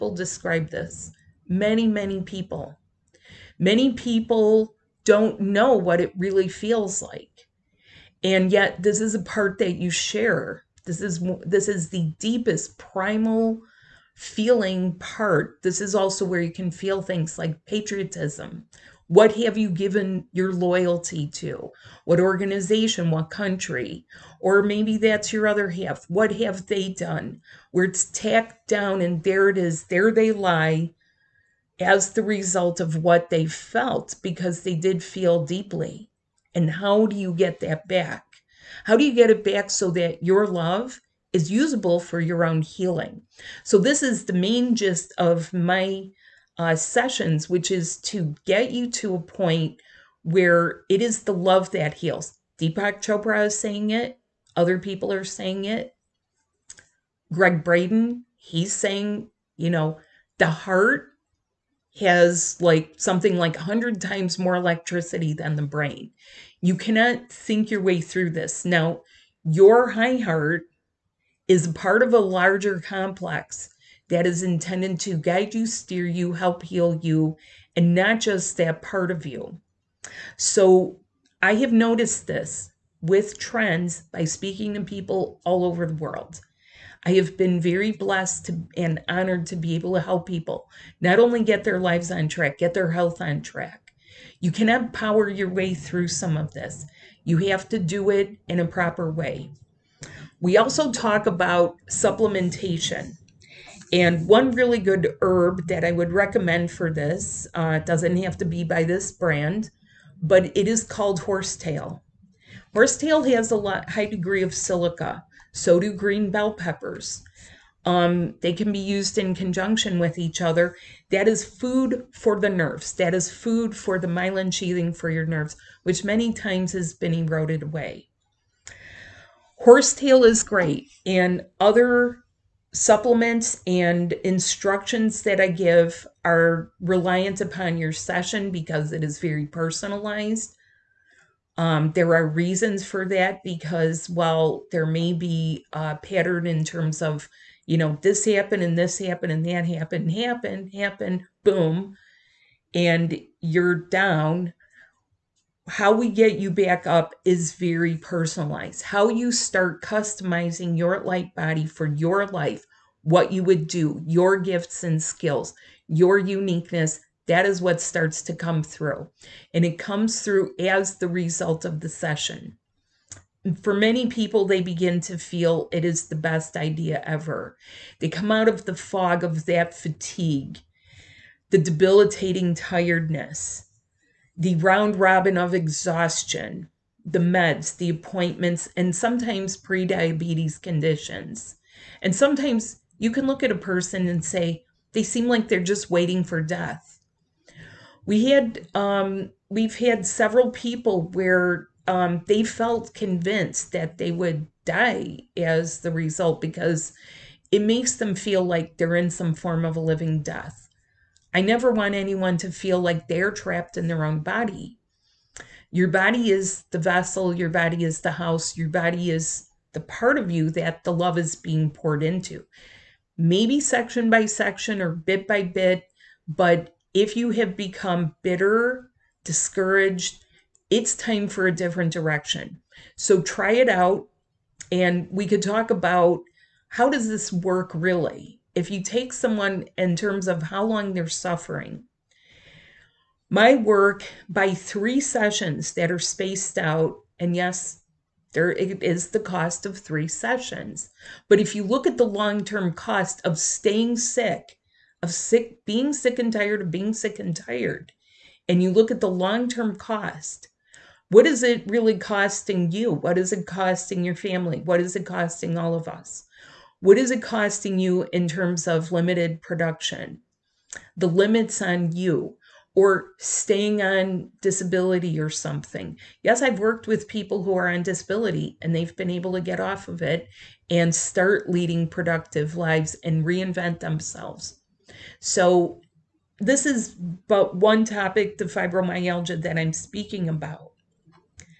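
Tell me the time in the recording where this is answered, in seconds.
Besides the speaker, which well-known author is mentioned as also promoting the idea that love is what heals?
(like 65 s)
52 s.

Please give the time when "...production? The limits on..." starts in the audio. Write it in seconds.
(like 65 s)
269 s.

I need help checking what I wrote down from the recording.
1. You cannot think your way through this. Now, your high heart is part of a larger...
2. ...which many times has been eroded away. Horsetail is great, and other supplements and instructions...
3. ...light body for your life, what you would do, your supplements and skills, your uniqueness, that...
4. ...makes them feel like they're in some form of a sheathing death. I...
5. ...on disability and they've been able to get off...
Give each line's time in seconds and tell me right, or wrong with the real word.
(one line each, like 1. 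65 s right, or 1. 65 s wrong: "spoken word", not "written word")
1. 66 s right
2. 125 s right
3. 161 s wrong: "gifts", not "supplements"
4. 207 s wrong: "living", not "sheathing"
5. 277 s right.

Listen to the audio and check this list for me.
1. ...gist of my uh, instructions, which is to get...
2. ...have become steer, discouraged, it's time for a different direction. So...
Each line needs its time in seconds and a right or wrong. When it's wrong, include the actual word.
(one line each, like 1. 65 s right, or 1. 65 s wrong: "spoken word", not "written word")
1. 44 s wrong: "sessions", not "instructions"
2. 227 s wrong: "bitter", not "steer".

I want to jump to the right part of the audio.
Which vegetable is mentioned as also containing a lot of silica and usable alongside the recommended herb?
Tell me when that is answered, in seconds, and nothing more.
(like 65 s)
115 s.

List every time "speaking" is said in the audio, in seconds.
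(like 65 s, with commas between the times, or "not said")
84 s, 289 s.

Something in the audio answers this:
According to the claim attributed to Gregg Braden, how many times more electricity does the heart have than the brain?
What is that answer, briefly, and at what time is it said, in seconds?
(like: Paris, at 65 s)
100 times, at 63 s.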